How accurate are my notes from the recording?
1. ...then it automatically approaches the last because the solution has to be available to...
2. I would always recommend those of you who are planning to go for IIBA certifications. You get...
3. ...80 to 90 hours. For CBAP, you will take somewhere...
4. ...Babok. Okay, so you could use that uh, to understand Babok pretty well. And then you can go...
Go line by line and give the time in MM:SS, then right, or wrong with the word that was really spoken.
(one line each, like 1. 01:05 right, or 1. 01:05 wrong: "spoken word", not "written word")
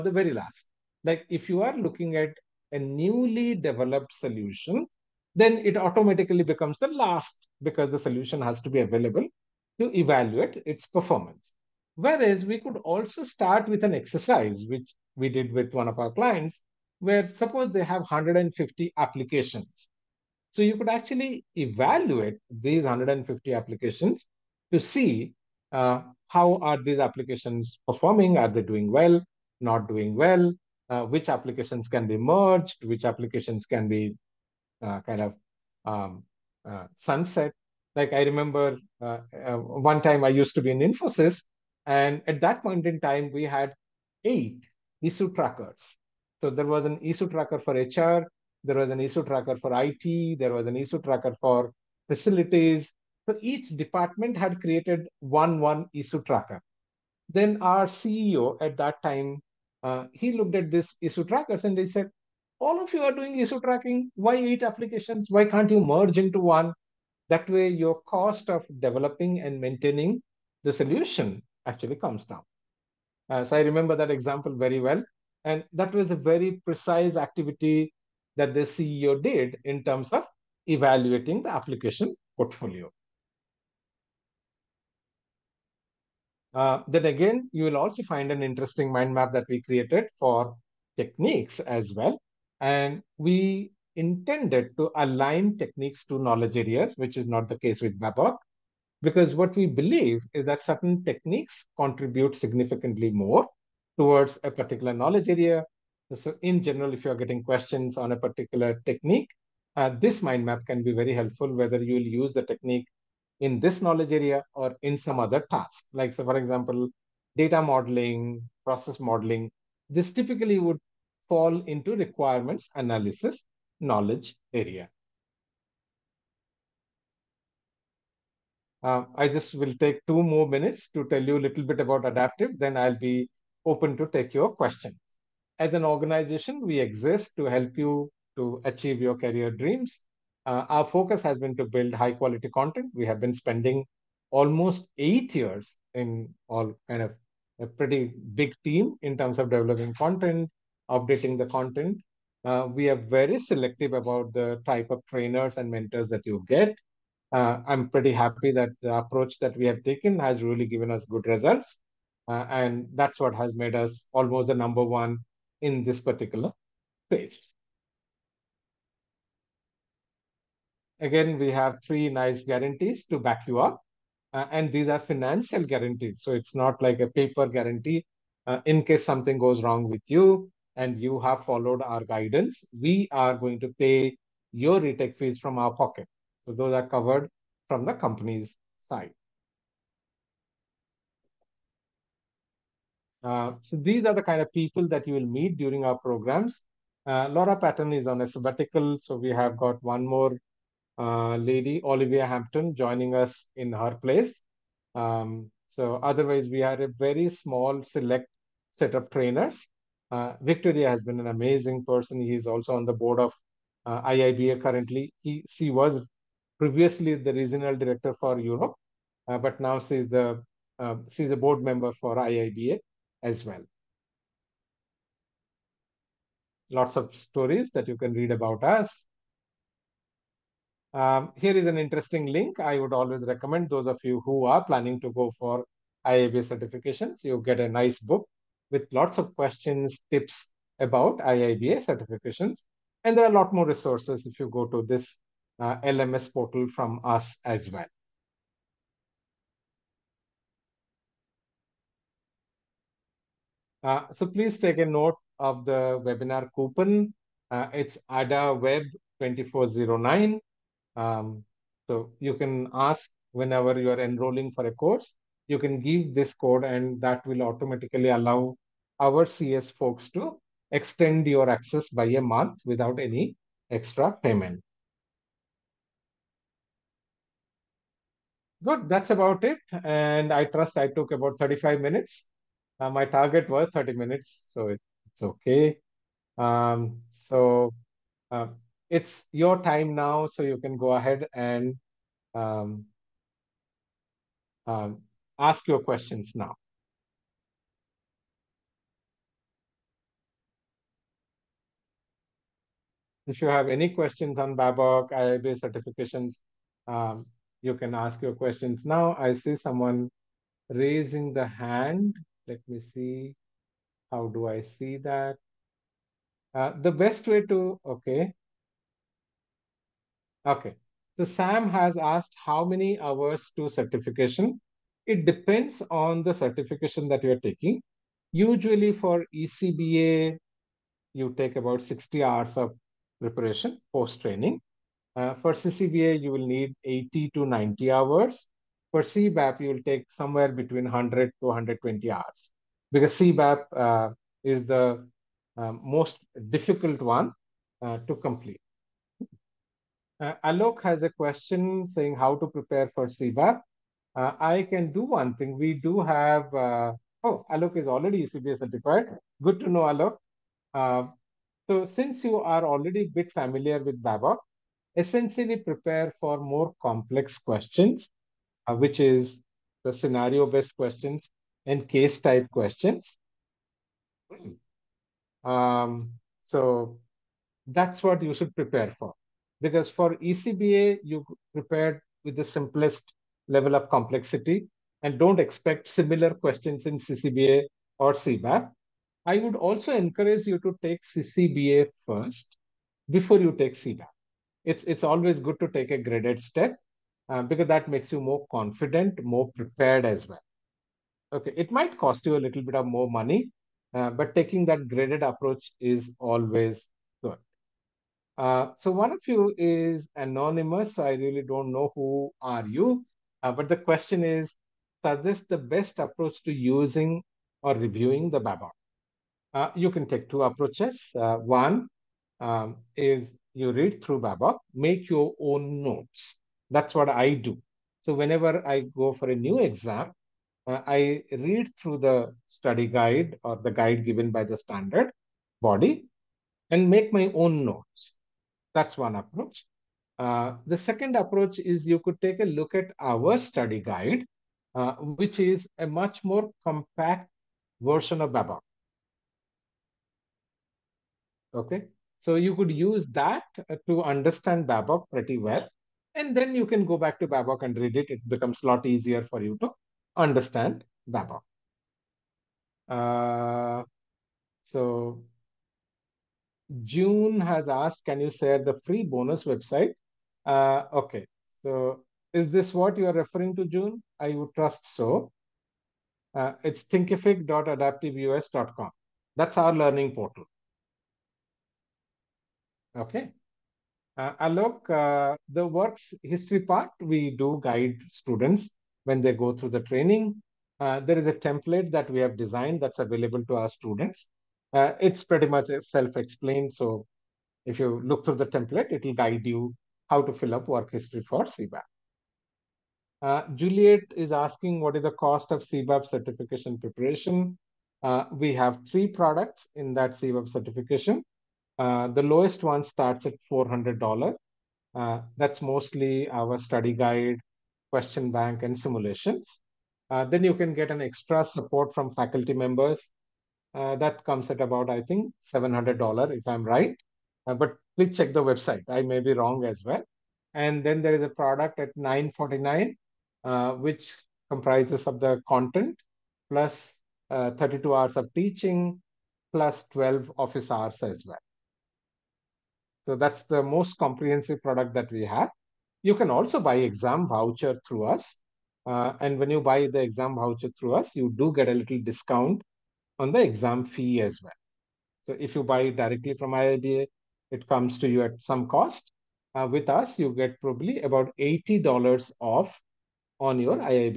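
1. 00:05 wrong: "becomes", not "approaches"
2. 03:52 right
3. 05:36 right
4. 07:28 right.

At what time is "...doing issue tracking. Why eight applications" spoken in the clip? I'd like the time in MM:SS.
01:03.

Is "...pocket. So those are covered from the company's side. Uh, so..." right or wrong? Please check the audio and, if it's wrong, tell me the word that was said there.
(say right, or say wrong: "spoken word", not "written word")
right.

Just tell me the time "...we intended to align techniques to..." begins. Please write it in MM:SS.
01:33.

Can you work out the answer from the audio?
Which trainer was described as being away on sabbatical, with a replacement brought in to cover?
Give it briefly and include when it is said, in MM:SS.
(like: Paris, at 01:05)
Laura Patton, at 03:17.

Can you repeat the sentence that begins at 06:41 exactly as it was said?
Okay, it might cost you a little bit of more money, uh, but taking that graded approach is always good.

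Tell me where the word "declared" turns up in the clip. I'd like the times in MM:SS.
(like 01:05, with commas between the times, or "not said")
not said.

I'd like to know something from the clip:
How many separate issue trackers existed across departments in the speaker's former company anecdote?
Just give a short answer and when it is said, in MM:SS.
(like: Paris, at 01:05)
8, at 00:44.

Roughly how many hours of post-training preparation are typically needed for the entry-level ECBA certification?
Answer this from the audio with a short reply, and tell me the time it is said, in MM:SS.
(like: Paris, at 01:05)
60 hours, at 05:31.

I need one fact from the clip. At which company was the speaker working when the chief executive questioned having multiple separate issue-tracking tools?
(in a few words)
Infosys.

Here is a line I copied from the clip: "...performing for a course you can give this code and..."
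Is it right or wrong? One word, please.
wrong.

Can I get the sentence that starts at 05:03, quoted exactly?
If you have any questions on Babok, IIBA certifications, um, you can ask your questions now.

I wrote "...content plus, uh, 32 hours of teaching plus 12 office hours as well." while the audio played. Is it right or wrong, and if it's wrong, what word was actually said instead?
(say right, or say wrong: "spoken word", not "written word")
right.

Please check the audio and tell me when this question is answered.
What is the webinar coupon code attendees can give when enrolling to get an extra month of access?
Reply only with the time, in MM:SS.
04:18.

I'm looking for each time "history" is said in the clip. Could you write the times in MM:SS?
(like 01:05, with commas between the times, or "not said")
08:06, 08:20.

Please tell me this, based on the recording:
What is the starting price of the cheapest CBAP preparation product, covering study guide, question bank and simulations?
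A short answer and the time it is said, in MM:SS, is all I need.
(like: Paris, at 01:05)
$400, at 08:33.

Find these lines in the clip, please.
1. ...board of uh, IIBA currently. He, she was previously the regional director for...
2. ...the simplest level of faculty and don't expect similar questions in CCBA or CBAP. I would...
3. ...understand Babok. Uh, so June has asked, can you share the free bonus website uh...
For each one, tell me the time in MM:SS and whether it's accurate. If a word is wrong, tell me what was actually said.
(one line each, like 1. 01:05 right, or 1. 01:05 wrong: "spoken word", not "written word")
1. 03:32 right
2. 06:22 wrong: "complexity", not "faculty"
3. 07:40 right.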